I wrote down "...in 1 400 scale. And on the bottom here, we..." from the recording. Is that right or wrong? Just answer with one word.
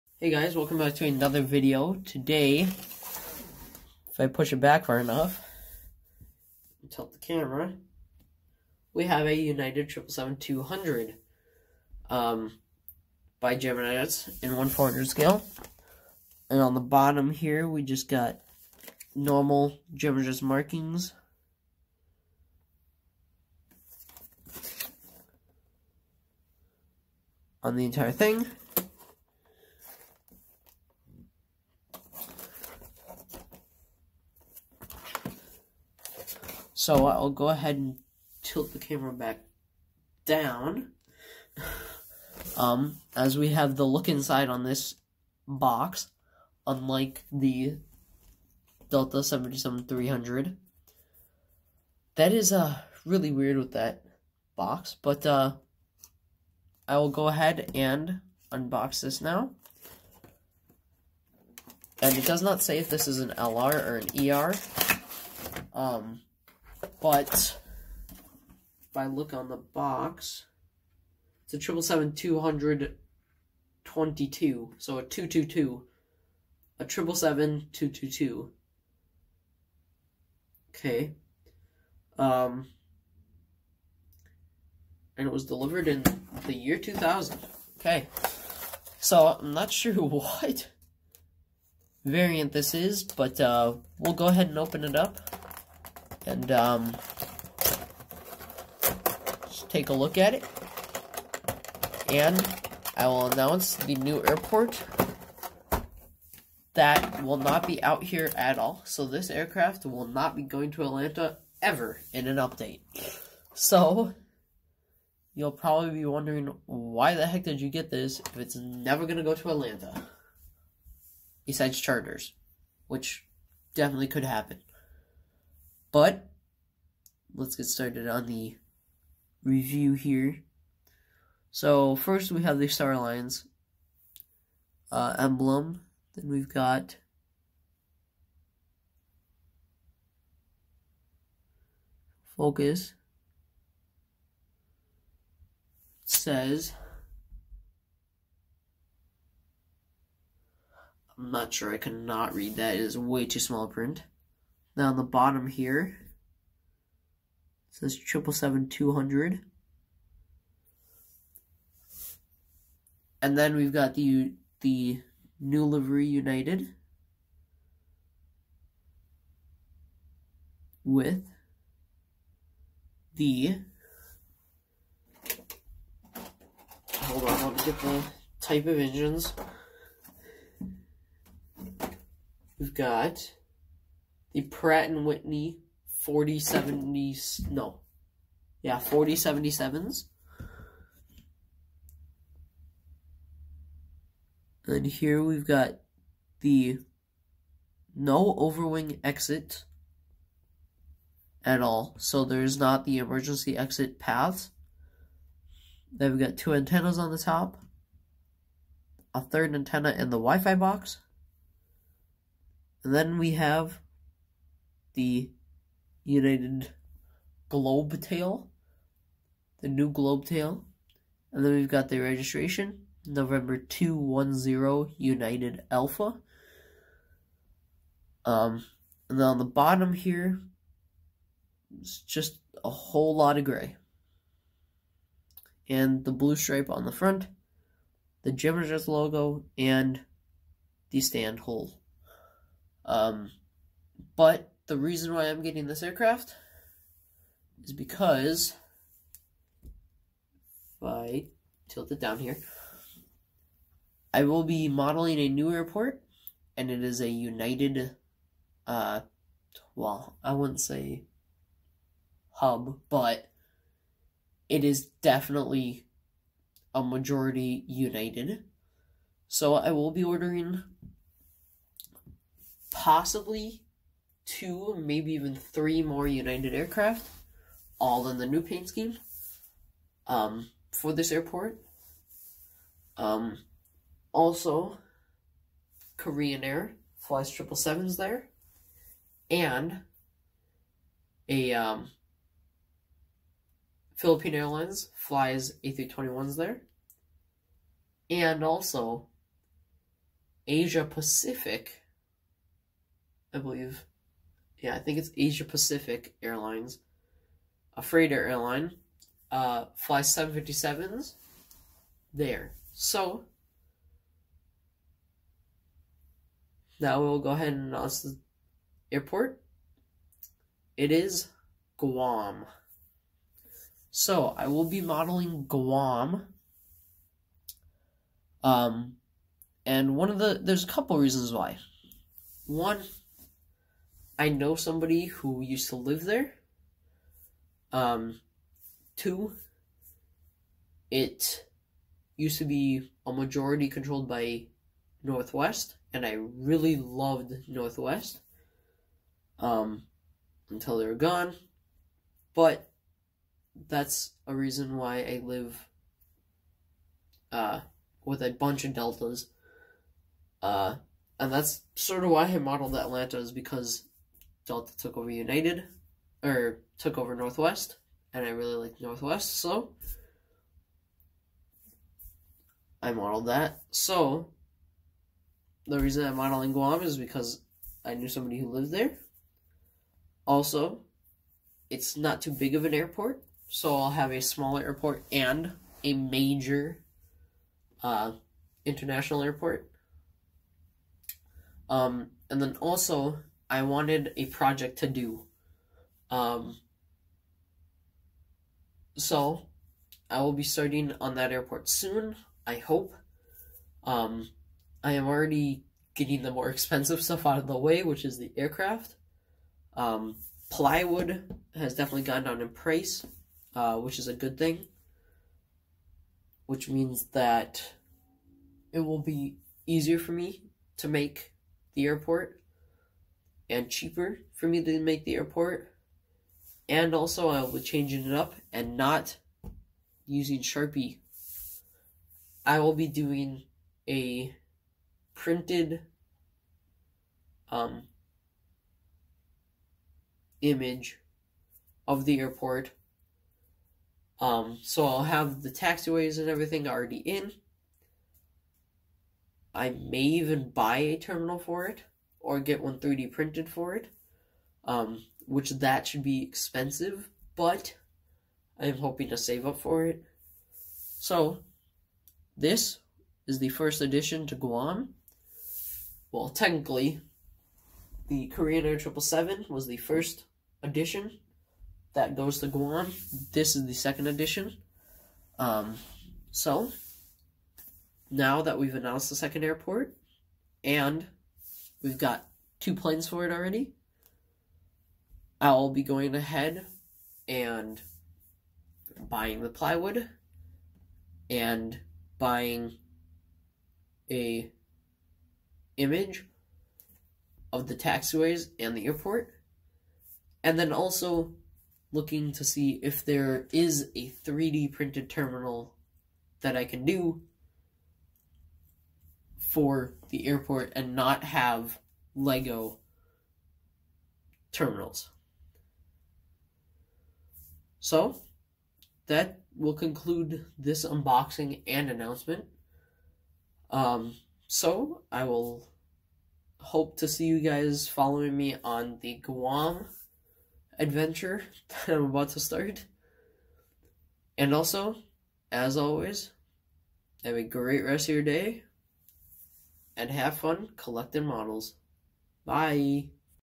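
right.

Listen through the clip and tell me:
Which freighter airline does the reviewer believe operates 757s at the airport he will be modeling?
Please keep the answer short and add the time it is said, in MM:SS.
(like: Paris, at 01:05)
Asia Pacific Airlines, at 05:05.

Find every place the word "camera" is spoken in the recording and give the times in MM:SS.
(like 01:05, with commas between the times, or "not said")
00:07, 00:38.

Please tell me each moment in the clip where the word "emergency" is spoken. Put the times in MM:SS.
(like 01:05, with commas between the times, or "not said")
03:22.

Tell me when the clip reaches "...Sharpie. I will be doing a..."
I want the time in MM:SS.
07:10.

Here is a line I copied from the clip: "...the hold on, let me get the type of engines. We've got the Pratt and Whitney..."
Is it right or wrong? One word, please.
right.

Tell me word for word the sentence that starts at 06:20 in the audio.
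Also, it's not too big of an airport, so I'll have a smaller airport and a major uh, international airport.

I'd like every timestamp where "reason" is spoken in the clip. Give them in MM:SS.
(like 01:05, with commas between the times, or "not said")
04:04, 05:30, 05:54, 06:15.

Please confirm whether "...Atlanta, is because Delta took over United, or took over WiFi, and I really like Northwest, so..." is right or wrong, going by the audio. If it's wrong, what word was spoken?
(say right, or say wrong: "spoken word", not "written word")
wrong: "Northwest", not "WiFi".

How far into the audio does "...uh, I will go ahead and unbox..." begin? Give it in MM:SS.
00:55.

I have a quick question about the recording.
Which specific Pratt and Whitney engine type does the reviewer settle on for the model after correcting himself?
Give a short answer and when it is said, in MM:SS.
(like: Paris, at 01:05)
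4077s, at 03:08.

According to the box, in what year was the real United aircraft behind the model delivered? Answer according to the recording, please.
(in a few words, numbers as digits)
2000.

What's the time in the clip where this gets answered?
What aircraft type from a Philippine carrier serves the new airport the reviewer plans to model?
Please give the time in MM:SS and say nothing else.
04:55.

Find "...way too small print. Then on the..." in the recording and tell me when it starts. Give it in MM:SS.
02:32.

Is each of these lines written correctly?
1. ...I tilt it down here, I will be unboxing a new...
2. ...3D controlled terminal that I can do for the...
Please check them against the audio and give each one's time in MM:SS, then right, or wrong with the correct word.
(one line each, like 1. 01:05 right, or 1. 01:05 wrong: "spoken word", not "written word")
1. 04:10 wrong: "modeling", not "unboxing"
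2. 08:24 wrong: "printed", not "controlled".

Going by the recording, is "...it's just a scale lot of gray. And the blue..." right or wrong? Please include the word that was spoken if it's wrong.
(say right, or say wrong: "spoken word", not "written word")
wrong: "whole", not "scale".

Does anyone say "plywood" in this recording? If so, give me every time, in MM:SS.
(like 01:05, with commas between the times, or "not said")
06:50, 08:09.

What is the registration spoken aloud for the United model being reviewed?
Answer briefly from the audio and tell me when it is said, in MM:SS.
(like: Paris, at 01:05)
N210UA, at 03:43.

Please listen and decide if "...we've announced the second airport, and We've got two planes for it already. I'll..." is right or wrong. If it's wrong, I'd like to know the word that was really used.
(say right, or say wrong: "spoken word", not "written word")
right.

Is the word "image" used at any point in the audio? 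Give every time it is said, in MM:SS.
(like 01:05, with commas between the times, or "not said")
07:20, 08:15.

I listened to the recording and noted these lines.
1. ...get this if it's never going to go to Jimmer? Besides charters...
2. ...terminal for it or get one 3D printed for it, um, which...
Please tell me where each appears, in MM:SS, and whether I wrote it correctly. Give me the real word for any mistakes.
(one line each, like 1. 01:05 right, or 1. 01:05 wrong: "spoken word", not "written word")
1. 01:57 wrong: "Atlanta", not "Jimmer"
2. 07:30 right.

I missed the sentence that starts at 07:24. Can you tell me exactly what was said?
Um, so I'll have the taxiways and everything already in.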